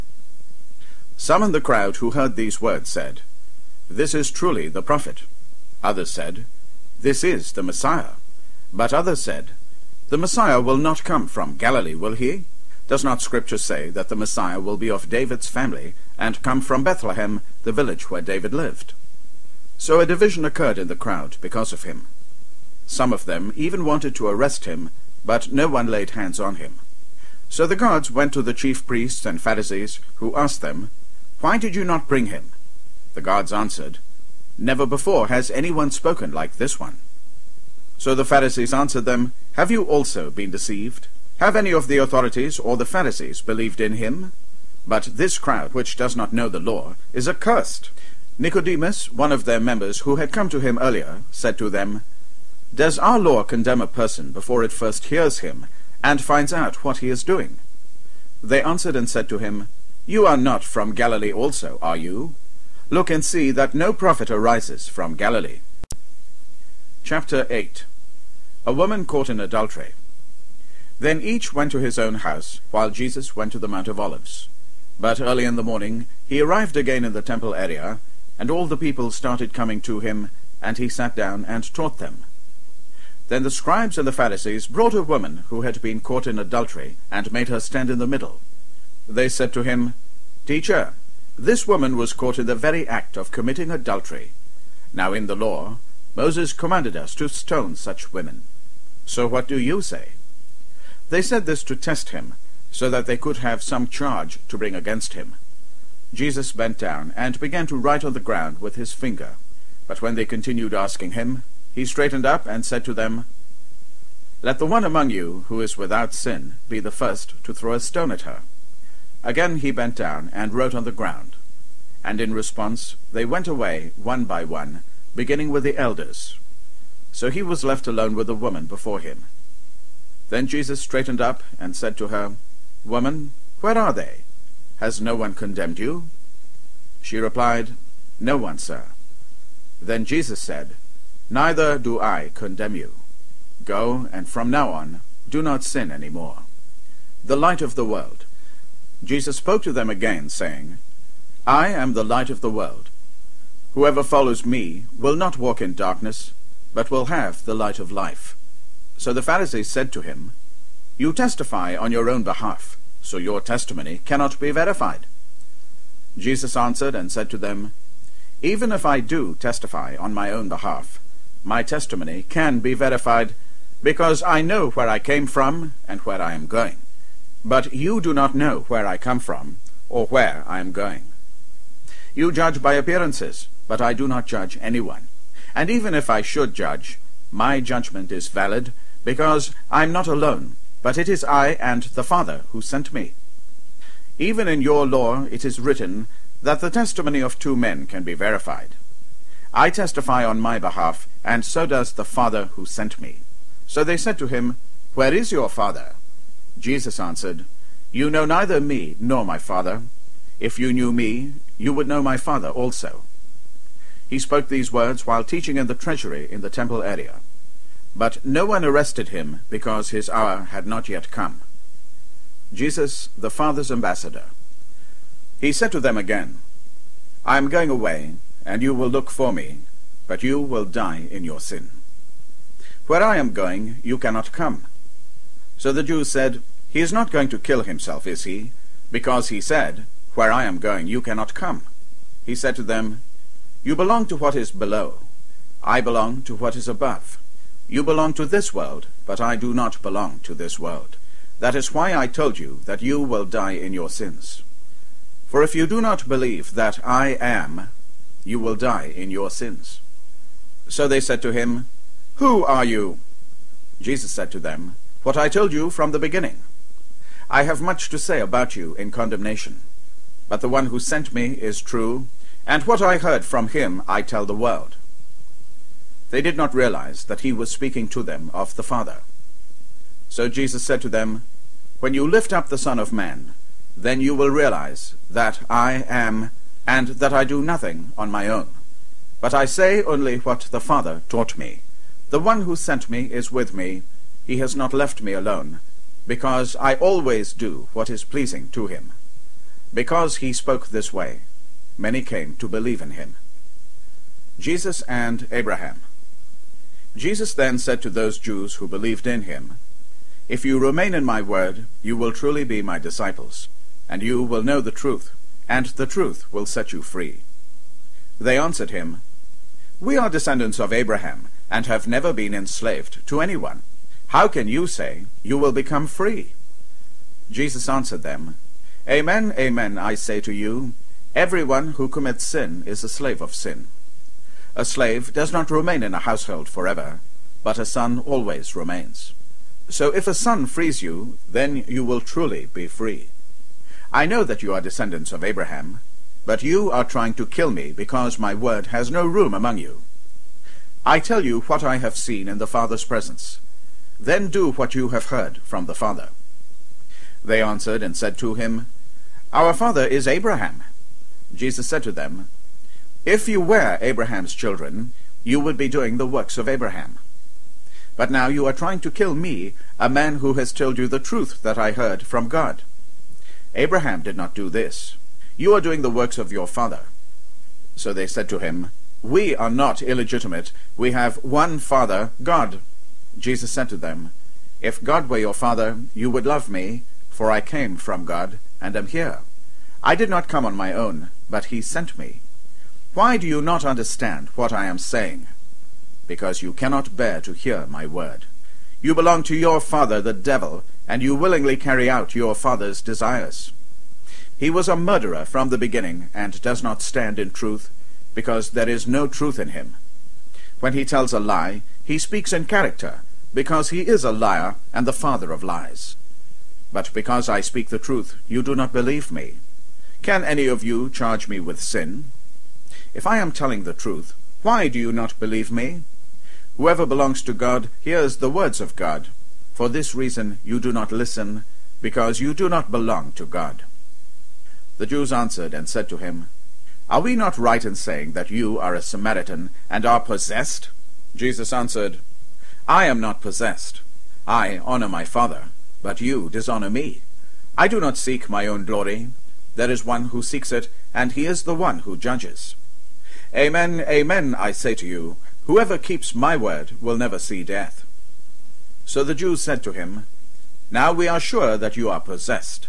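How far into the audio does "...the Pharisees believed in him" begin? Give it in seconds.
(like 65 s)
42 s.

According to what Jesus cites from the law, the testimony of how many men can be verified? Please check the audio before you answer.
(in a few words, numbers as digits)
2.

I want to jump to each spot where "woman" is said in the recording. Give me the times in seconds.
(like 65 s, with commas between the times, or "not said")
68 s, 85 s, 91 s, 128 s, 132 s.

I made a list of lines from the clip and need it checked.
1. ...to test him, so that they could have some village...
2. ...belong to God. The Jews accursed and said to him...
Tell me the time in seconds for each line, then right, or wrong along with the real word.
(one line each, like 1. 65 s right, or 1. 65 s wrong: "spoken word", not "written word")
1. 101 s wrong: "charge", not "village"
2. 432 s wrong: "answered", not "accursed".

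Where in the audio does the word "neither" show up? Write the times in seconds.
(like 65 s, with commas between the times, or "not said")
141 s, 208 s.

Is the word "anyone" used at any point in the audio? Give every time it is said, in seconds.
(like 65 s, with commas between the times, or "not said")
35 s, 184 s, 323 s.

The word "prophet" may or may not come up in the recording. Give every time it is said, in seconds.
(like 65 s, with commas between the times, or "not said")
4 s, 63 s.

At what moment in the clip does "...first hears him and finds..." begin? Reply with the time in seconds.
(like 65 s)
54 s.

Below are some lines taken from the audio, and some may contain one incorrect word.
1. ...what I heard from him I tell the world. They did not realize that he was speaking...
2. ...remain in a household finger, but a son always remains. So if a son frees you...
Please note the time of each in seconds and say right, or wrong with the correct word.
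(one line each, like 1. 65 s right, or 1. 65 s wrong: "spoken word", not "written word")
1. 272 s right
2. 335 s wrong: "forever", not "finger".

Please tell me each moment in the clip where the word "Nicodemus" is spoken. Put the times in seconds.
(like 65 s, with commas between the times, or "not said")
48 s.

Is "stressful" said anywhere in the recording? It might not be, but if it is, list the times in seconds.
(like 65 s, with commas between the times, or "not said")
not said.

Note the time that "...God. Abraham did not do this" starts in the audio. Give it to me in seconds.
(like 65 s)
372 s.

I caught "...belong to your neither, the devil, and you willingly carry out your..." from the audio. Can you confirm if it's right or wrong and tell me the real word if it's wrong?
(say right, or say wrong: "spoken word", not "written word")
wrong: "father", not "neither".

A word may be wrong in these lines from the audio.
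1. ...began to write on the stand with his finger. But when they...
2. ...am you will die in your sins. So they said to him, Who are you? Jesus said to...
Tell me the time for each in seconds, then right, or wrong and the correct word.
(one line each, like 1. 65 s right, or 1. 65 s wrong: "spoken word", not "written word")
1. 107 s wrong: "ground", not "stand"
2. 257 s right.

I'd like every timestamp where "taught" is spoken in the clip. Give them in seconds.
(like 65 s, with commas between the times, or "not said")
81 s, 291 s.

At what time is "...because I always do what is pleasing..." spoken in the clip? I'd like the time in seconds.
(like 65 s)
296 s.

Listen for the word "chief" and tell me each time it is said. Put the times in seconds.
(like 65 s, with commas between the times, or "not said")
28 s.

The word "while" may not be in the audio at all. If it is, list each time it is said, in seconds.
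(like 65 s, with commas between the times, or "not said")
72 s, 215 s.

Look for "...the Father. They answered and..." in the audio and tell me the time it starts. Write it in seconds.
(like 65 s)
355 s.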